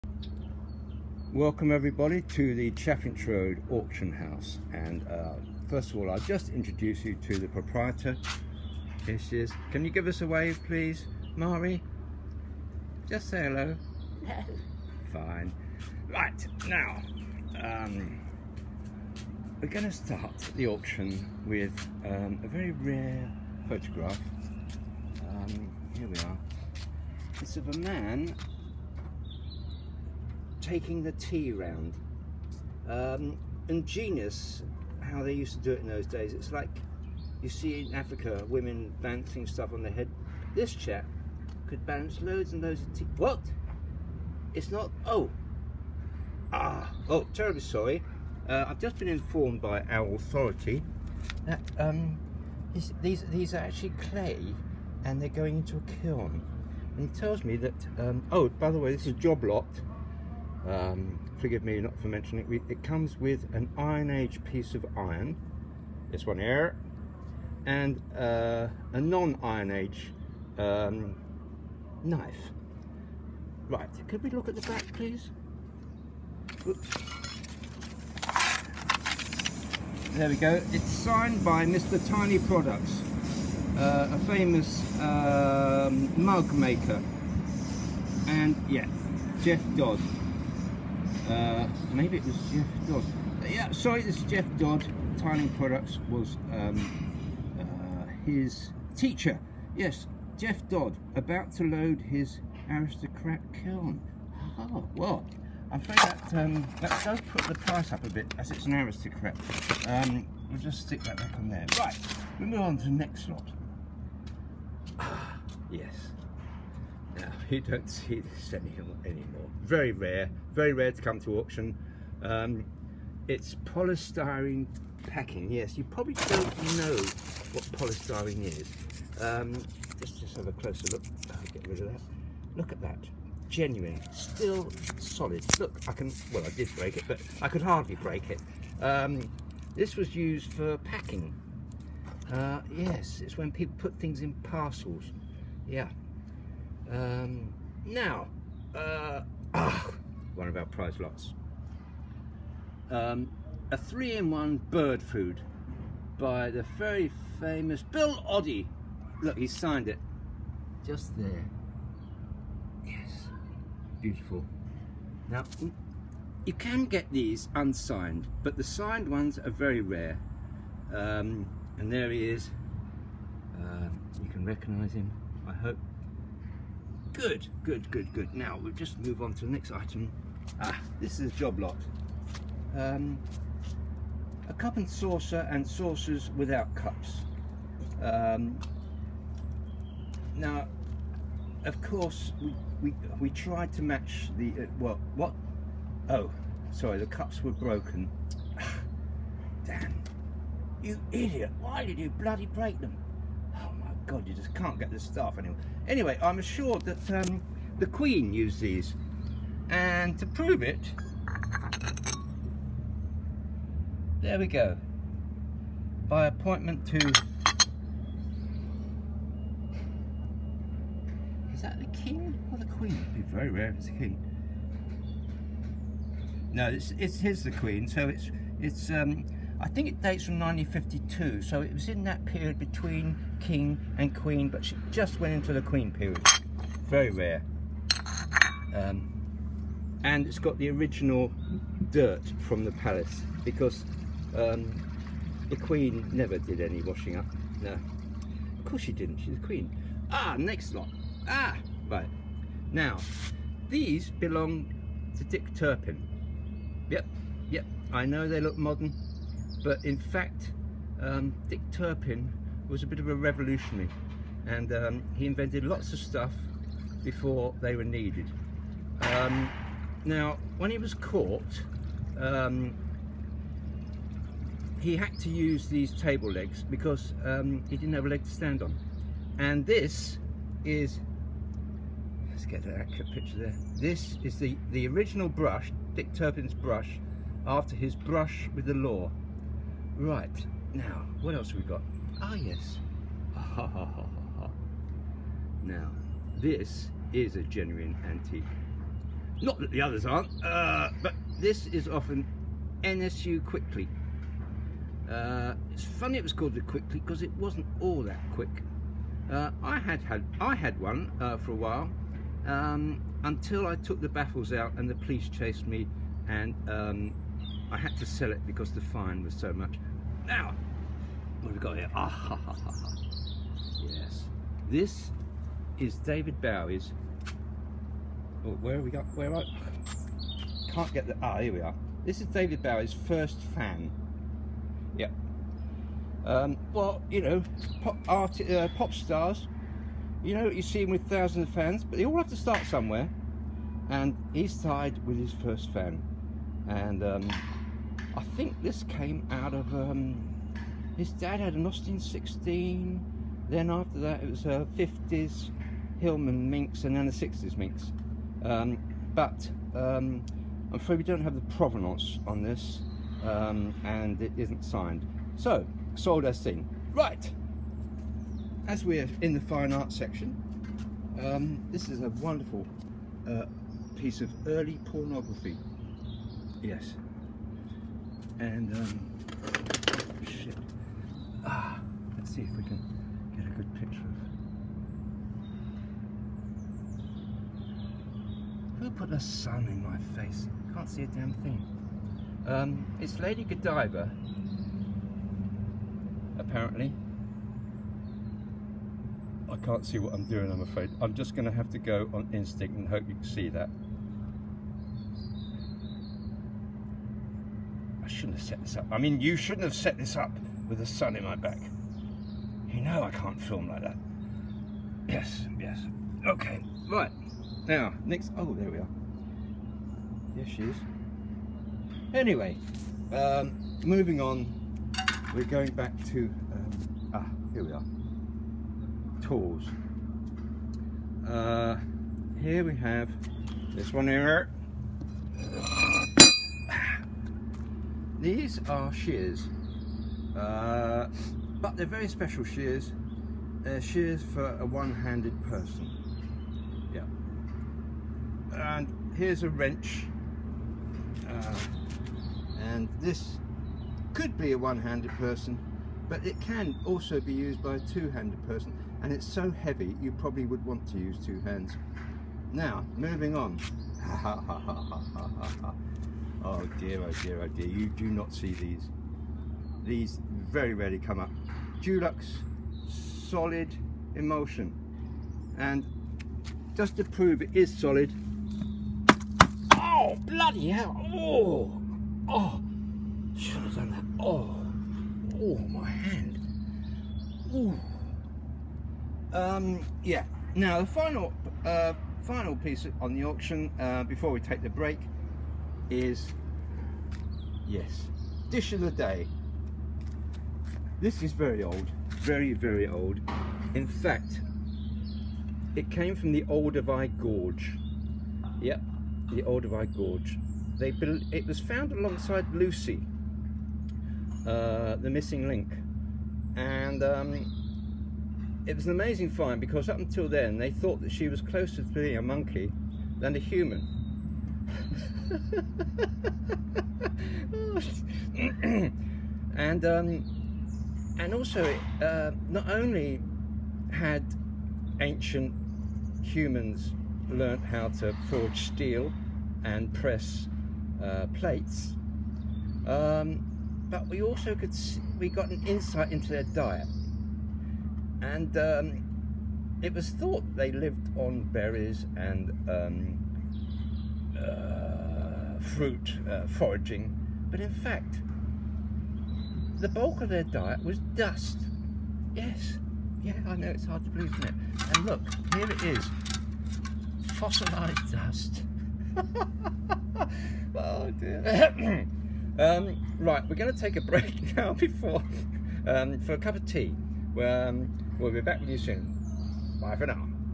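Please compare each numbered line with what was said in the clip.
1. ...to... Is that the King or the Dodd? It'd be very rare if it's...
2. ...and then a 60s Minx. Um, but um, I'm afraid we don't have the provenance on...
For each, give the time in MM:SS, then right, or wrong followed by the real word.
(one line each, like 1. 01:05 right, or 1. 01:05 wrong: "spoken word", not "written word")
1. 03:36 wrong: "Queen", not "Dodd"
2. 05:56 right.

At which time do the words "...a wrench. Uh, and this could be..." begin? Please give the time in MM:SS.
07:29.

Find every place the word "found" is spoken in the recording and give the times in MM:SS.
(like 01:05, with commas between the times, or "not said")
08:31.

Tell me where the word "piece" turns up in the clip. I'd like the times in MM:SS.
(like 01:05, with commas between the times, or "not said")
01:04, 06:13, 08:12.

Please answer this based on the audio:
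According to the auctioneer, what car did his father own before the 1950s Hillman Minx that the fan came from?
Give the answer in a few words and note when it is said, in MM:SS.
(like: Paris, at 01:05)
Austin 16, at 05:51.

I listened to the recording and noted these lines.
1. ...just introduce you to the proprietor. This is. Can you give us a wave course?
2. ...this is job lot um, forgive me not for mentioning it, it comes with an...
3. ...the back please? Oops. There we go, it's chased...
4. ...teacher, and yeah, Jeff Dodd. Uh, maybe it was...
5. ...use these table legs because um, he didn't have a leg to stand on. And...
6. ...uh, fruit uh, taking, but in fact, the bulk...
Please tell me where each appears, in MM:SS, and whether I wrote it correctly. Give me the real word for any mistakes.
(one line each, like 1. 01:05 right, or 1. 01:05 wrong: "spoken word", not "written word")
1. 00:06 wrong: "please", not "course"
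2. 00:58 right
3. 01:14 wrong: "signed", not "chased"
4. 01:26 wrong: "maker", not "teacher"
5. 04:35 right
6. 09:14 wrong: "foraging", not "taking".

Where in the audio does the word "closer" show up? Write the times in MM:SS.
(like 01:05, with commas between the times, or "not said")
02:10, 08:41.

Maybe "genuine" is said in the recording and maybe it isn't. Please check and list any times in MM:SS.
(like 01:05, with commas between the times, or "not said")
02:13, 04:57.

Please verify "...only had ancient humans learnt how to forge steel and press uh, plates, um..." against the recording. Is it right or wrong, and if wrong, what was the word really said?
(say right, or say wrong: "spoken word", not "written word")
right.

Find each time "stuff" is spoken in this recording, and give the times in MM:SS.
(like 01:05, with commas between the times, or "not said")
00:39, 03:25, 04:25.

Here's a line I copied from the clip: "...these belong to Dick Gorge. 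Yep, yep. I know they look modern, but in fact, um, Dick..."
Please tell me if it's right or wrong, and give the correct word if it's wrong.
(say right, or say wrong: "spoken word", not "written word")
wrong: "Turpin", not "Gorge".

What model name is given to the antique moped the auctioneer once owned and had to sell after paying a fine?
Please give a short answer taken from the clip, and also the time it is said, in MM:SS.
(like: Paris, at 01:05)
NSU Quickly, at 05:02.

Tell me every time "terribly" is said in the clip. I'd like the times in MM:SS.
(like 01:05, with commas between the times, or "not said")
00:47.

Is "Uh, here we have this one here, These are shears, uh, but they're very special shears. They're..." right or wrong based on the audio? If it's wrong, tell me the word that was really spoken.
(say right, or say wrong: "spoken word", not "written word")
right.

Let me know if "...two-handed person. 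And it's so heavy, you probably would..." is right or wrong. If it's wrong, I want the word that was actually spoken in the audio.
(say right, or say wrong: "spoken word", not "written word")
right.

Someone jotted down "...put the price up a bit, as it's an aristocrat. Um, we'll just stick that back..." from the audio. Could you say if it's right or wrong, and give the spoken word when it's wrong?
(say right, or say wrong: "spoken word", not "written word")
right.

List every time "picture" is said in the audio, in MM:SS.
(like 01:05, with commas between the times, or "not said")
04:43, 06:23.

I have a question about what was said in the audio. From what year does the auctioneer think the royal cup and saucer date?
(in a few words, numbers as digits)
1952.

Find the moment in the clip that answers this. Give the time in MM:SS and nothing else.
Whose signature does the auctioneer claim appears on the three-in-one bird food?
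02:37.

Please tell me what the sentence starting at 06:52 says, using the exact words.
You know I can't film like that.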